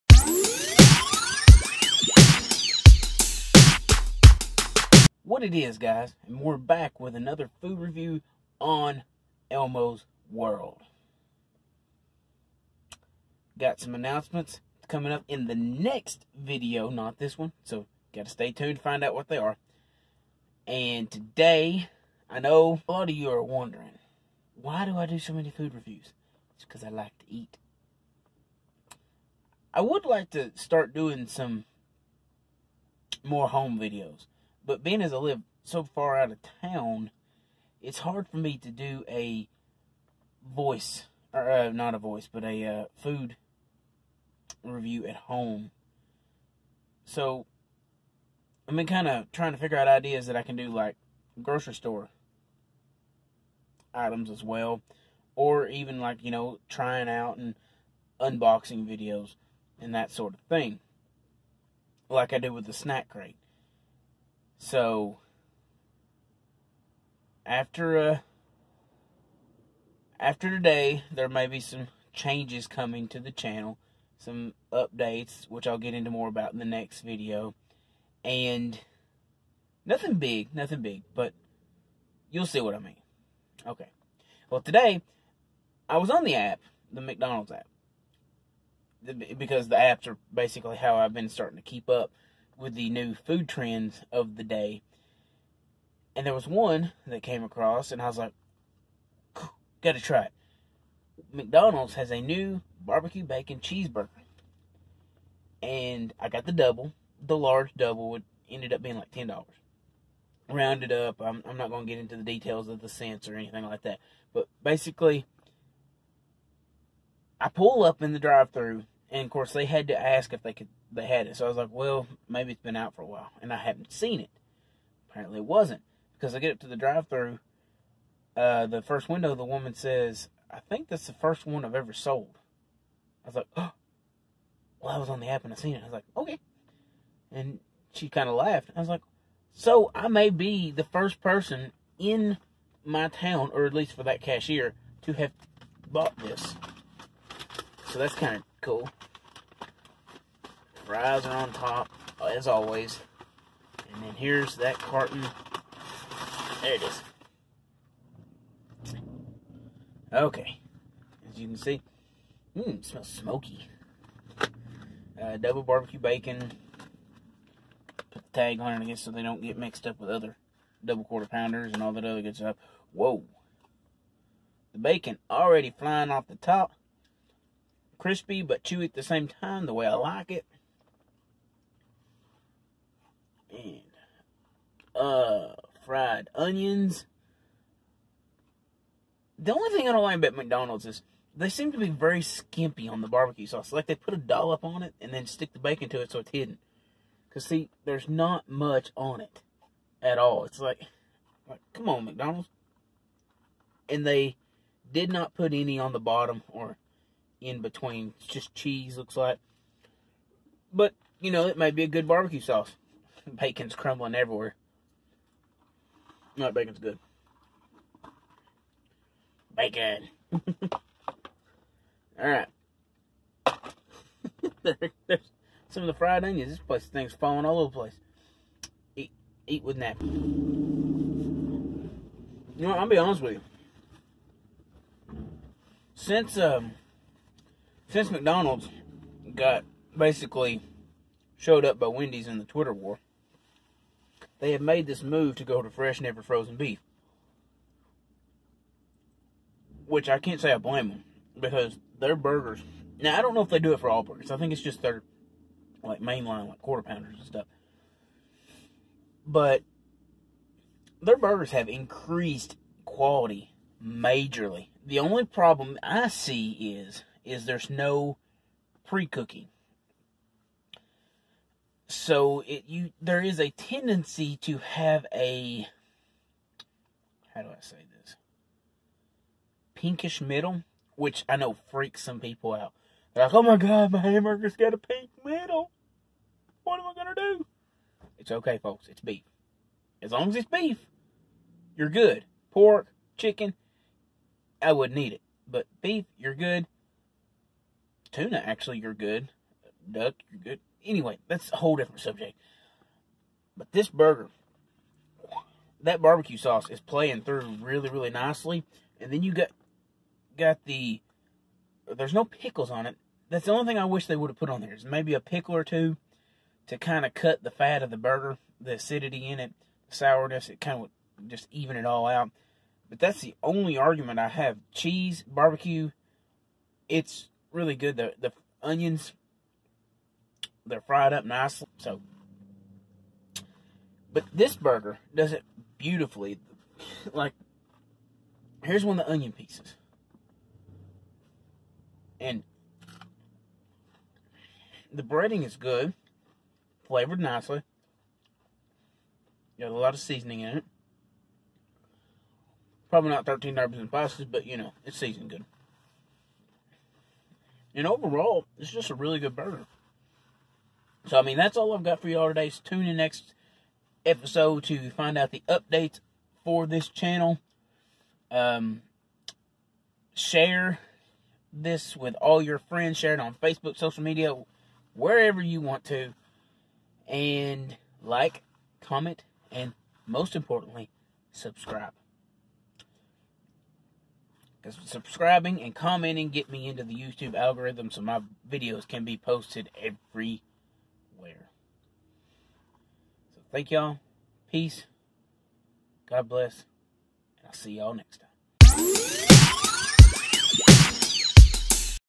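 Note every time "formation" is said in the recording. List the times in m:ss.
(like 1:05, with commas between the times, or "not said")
not said.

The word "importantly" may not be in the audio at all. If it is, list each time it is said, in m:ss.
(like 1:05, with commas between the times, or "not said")
6:20.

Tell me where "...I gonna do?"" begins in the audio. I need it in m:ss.
4:46.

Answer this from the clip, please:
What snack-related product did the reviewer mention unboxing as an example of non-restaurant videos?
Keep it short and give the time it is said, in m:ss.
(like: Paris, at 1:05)
Snack crate, at 1:02.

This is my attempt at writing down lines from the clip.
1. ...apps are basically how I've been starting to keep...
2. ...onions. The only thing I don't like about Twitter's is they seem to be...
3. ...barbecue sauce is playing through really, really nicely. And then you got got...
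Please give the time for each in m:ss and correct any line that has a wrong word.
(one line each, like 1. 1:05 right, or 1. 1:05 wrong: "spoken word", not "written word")
1. 1:29 right
2. 3:06 wrong: "McDonald", not "Twitter"
3. 5:06 right.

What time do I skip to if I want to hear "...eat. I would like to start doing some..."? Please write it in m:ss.
0:27.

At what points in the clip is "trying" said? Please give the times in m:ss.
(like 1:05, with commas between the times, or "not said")
0:49, 0:56.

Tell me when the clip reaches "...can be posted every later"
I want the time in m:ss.
6:28.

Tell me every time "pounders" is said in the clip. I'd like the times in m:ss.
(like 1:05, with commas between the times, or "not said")
2:51, 4:16.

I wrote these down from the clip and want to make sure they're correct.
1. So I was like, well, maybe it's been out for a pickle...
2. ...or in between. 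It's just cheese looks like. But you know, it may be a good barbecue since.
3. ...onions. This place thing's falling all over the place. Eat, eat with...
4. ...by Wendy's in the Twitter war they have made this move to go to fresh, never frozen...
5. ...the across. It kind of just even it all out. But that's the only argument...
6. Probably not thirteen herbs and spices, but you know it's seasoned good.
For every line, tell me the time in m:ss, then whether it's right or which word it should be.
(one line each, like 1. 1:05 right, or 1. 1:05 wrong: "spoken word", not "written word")
1. 2:01 wrong: "while", not "pickle"
2. 3:26 wrong: "sauce", not "since"
3. 3:46 right
4. 4:01 right
5. 5:19 wrong: "sourness", not "across"
6. 5:52 right.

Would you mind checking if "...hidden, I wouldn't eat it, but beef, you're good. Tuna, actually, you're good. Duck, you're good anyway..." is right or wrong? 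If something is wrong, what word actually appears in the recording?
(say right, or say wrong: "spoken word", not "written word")
wrong: "chicken", not "hidden".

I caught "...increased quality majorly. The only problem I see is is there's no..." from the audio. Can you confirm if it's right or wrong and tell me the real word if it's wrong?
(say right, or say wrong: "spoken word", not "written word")
right.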